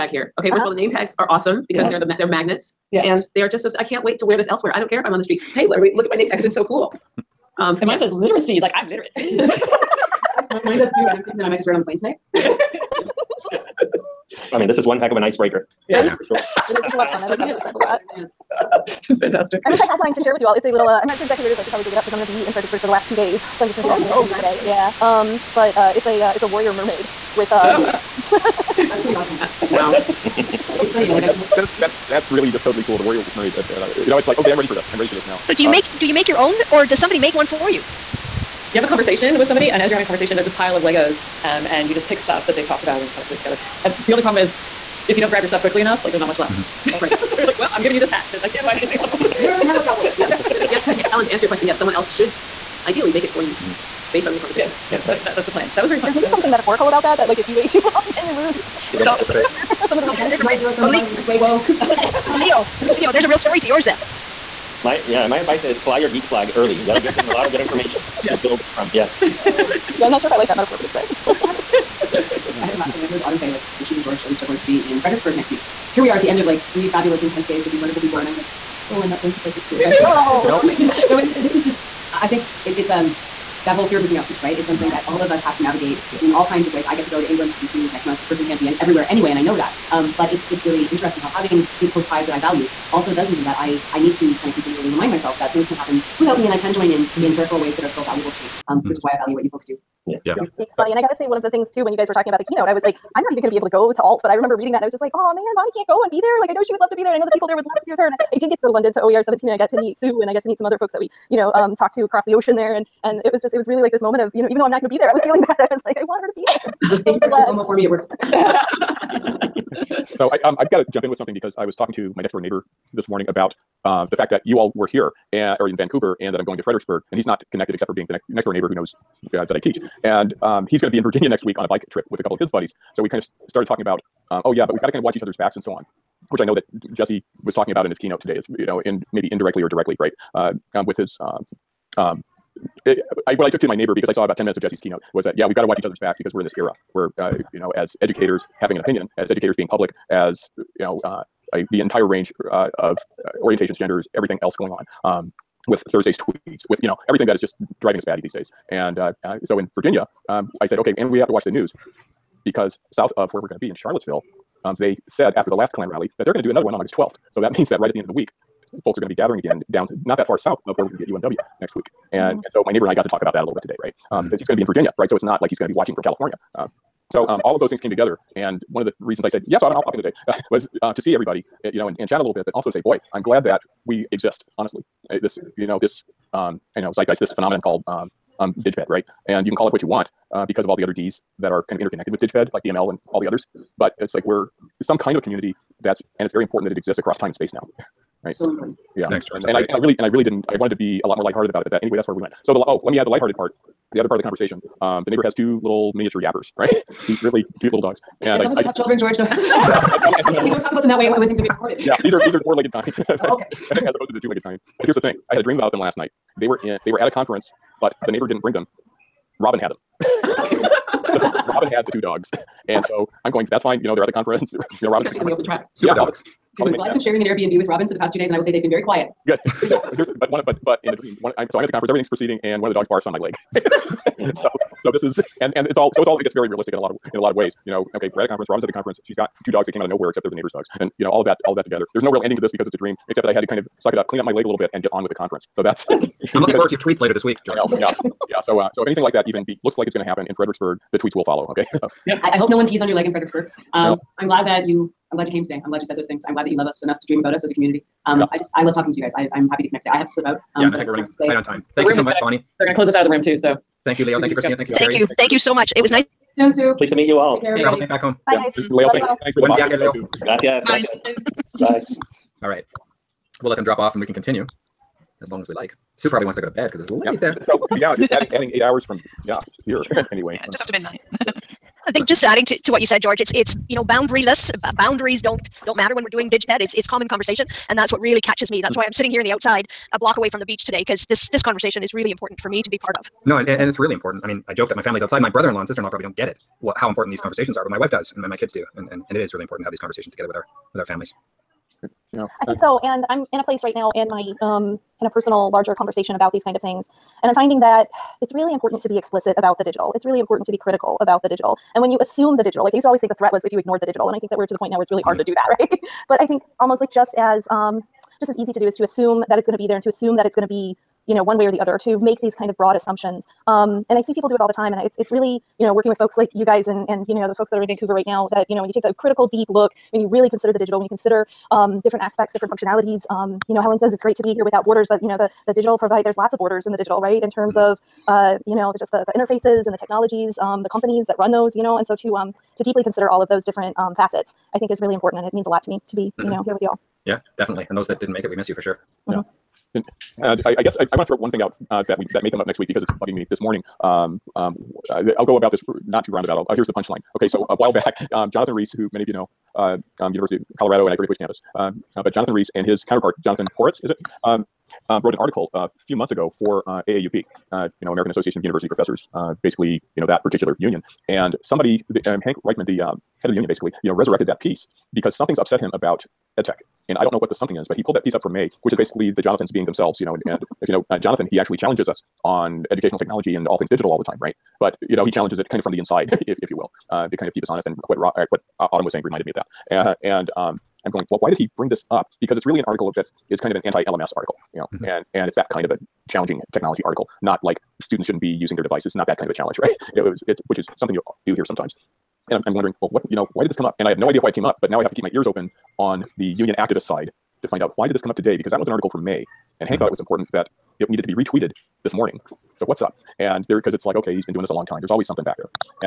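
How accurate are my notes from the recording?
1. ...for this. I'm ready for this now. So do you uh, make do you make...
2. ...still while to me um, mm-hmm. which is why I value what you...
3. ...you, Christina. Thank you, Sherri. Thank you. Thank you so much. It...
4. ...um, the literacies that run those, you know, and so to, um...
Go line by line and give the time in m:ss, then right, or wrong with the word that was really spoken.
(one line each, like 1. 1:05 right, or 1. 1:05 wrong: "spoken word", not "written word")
1. 0:34 right
2. 1:37 wrong: "valuable", not "while"
3. 4:24 right
4. 5:40 wrong: "companies", not "literacies".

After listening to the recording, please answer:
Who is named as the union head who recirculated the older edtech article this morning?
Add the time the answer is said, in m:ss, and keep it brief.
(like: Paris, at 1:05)
Hank Reichman, at 6:12.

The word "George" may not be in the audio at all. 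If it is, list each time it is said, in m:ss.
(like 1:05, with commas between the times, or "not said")
1:14, 3:19, 3:28, 4:07, 4:43.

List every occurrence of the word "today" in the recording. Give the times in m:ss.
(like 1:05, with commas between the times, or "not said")
2:18, 2:53, 2:59, 4:15, 4:19, 4:50, 6:48.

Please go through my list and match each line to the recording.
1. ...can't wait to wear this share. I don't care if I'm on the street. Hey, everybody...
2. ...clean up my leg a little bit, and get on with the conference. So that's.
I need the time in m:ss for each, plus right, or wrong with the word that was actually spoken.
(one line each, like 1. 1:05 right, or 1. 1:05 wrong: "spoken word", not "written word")
1. 0:03 wrong: "elsewhere", not "share"
2. 4:04 right.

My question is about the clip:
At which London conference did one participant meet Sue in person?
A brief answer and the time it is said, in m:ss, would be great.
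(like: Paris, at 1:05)
OER 17, at 1:49.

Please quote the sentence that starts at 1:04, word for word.
My yeah, my advice is fly your geek flag early.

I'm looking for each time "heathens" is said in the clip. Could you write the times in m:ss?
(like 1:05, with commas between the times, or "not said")
not said.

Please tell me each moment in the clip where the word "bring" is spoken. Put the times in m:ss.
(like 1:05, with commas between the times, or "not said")
3:38, 6:31.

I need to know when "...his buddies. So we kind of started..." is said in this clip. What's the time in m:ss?
2:12.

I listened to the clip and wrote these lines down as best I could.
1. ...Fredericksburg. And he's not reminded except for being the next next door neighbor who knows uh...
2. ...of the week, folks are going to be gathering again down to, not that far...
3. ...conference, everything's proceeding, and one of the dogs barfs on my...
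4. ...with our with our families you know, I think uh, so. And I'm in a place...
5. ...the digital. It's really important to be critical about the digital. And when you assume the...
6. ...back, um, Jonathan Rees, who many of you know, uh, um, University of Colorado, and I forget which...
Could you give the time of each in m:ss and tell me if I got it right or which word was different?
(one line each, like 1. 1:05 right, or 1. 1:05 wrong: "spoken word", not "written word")
1. 2:06 wrong: "connected", not "reminded"
2. 2:48 right
3. 3:51 right
4. 5:00 right
5. 5:09 right
6. 5:57 right.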